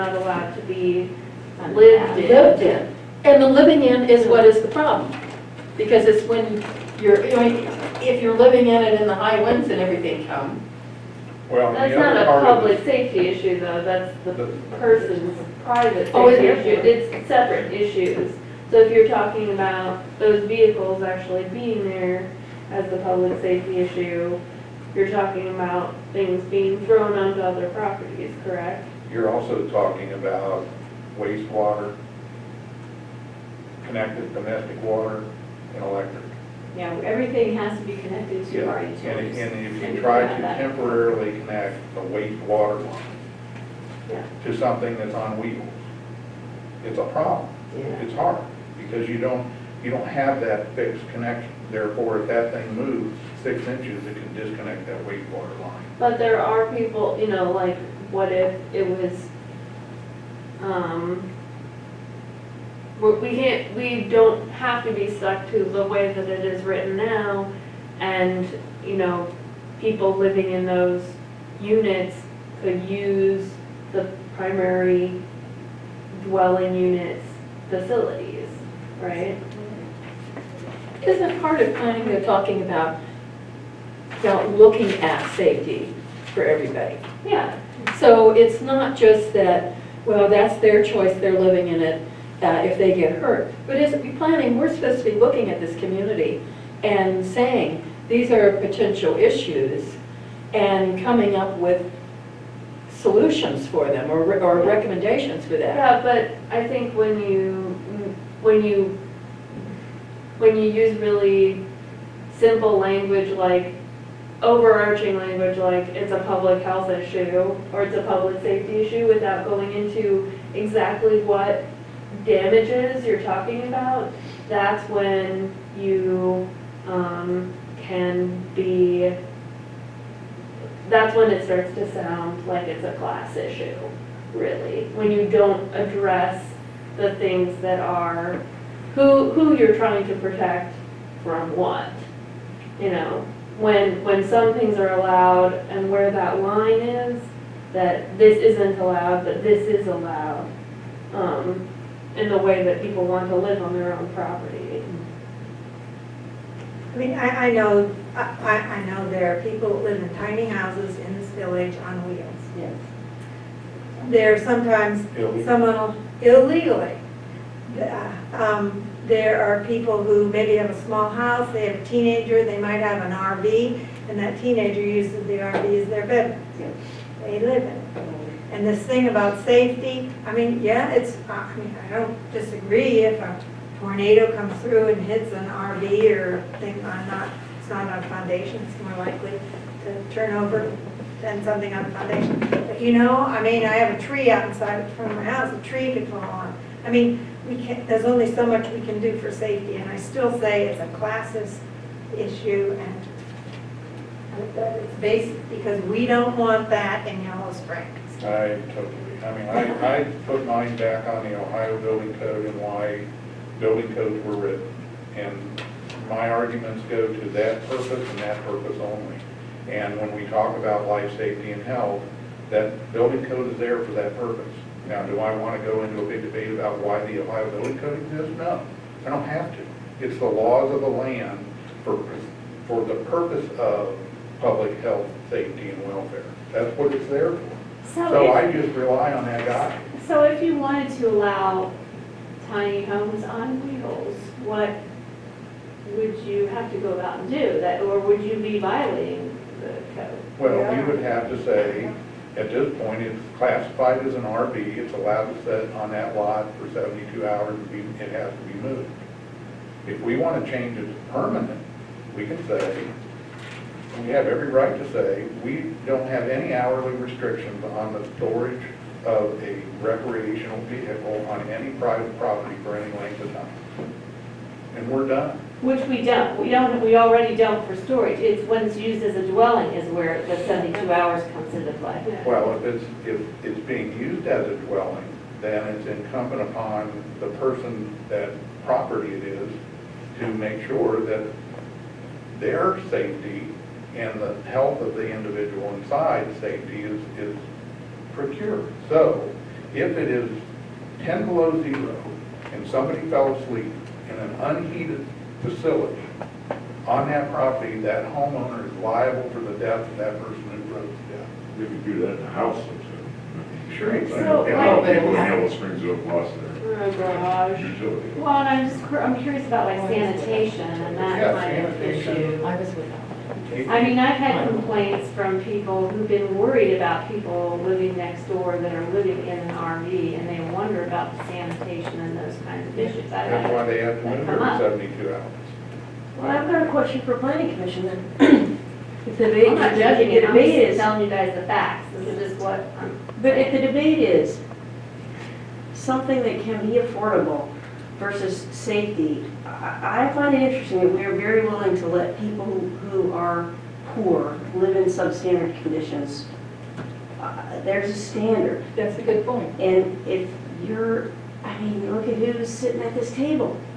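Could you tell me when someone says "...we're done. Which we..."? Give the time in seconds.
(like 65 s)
274 s.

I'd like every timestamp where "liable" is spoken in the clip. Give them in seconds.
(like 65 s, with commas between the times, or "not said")
308 s.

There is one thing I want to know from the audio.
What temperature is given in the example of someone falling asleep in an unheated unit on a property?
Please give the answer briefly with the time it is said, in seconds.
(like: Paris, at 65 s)
10 below zero, at 300 s.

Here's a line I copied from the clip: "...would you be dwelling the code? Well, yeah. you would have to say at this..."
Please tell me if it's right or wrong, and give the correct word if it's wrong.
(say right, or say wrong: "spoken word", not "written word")
wrong: "violating", not "dwelling".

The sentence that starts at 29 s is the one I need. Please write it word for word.
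You're also talking about wastewater, connected domestic water, and electric.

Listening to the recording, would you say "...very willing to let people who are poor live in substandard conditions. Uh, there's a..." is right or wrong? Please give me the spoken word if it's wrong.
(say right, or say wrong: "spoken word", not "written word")
right.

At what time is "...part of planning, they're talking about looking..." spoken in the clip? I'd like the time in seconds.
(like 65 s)
81 s.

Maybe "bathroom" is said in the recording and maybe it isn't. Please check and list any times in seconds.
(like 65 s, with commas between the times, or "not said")
not said.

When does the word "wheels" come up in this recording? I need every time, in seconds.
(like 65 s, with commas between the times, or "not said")
45 s, 162 s, 243 s.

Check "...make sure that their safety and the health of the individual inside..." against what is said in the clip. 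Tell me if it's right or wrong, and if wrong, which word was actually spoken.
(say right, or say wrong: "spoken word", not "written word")
right.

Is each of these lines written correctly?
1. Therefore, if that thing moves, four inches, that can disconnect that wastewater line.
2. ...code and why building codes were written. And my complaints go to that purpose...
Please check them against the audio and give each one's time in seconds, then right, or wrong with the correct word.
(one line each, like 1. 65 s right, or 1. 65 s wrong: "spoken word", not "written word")
1. 51 s wrong: "six", not "four"
2. 212 s wrong: "arguments", not "complaints".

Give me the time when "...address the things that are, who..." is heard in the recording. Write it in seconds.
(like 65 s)
135 s.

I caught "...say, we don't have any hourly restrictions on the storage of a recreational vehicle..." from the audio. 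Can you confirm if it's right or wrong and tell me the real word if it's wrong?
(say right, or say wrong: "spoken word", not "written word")
right.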